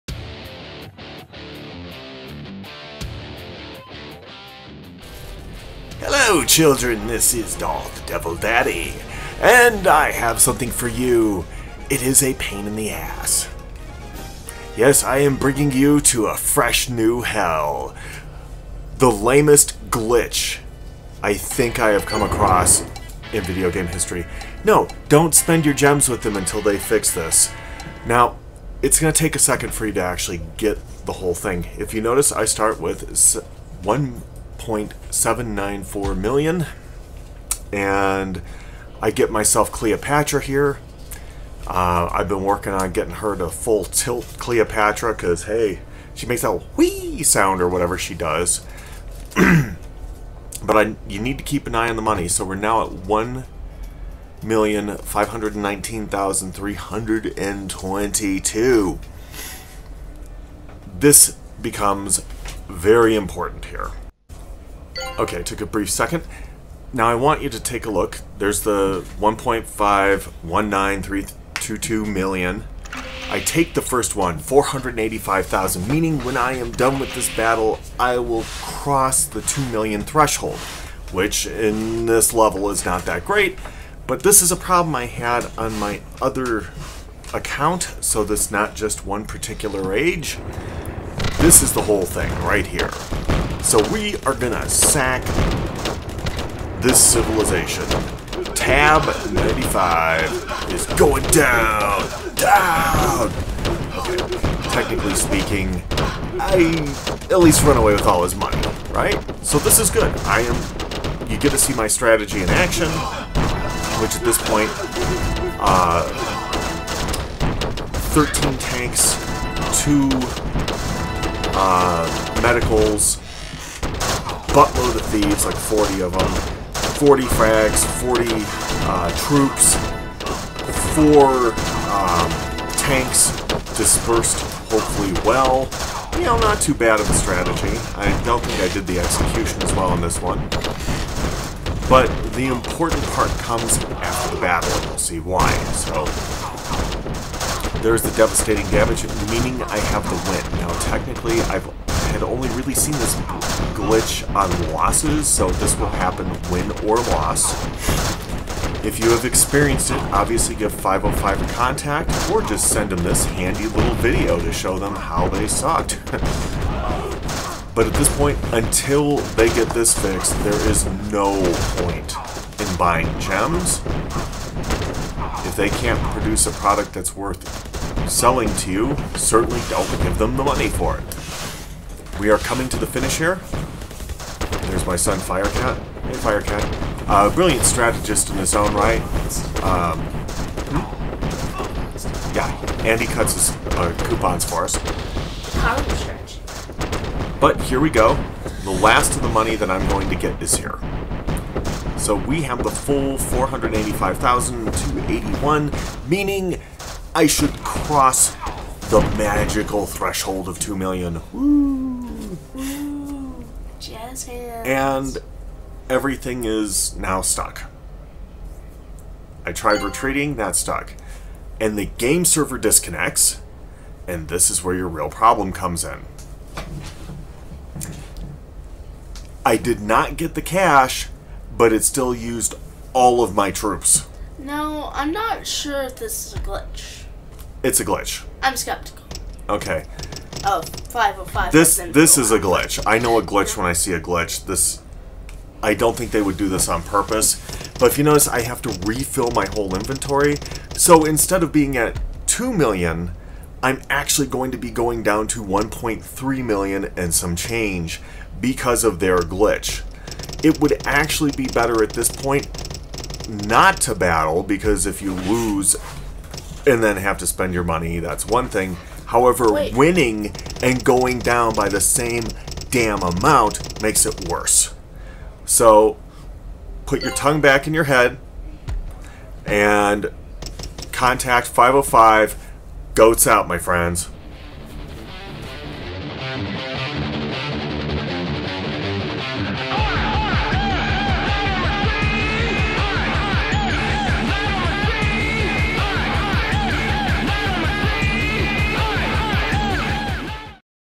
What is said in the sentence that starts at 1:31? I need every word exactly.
This is the whole thing right here.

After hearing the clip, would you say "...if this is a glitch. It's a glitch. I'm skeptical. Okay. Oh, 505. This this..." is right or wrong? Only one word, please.
right.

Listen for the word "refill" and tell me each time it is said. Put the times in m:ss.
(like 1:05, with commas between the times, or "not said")
4:08.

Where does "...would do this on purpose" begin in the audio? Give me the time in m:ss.
4:06.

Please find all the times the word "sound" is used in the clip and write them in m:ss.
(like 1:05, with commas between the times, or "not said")
0:47.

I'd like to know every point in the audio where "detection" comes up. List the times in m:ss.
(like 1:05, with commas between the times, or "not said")
not said.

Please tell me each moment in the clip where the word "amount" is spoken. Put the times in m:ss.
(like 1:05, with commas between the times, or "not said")
4:33.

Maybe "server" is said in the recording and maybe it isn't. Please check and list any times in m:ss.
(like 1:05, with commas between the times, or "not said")
3:42.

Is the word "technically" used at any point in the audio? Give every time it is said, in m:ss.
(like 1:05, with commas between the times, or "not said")
1:44, 2:30.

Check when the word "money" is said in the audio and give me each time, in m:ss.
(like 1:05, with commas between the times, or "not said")
0:52, 1:48, 3:00, 3:19, 4:27.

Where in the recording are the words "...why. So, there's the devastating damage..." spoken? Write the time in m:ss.
2:25.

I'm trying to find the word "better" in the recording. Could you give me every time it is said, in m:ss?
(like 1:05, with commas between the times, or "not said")
4:21.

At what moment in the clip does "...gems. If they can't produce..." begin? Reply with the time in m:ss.
2:53.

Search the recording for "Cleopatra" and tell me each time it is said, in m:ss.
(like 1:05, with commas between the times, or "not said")
0:39, 0:44.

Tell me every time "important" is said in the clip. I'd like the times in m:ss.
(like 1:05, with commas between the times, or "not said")
1:03, 2:22.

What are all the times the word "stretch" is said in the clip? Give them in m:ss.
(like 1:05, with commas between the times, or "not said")
3:15.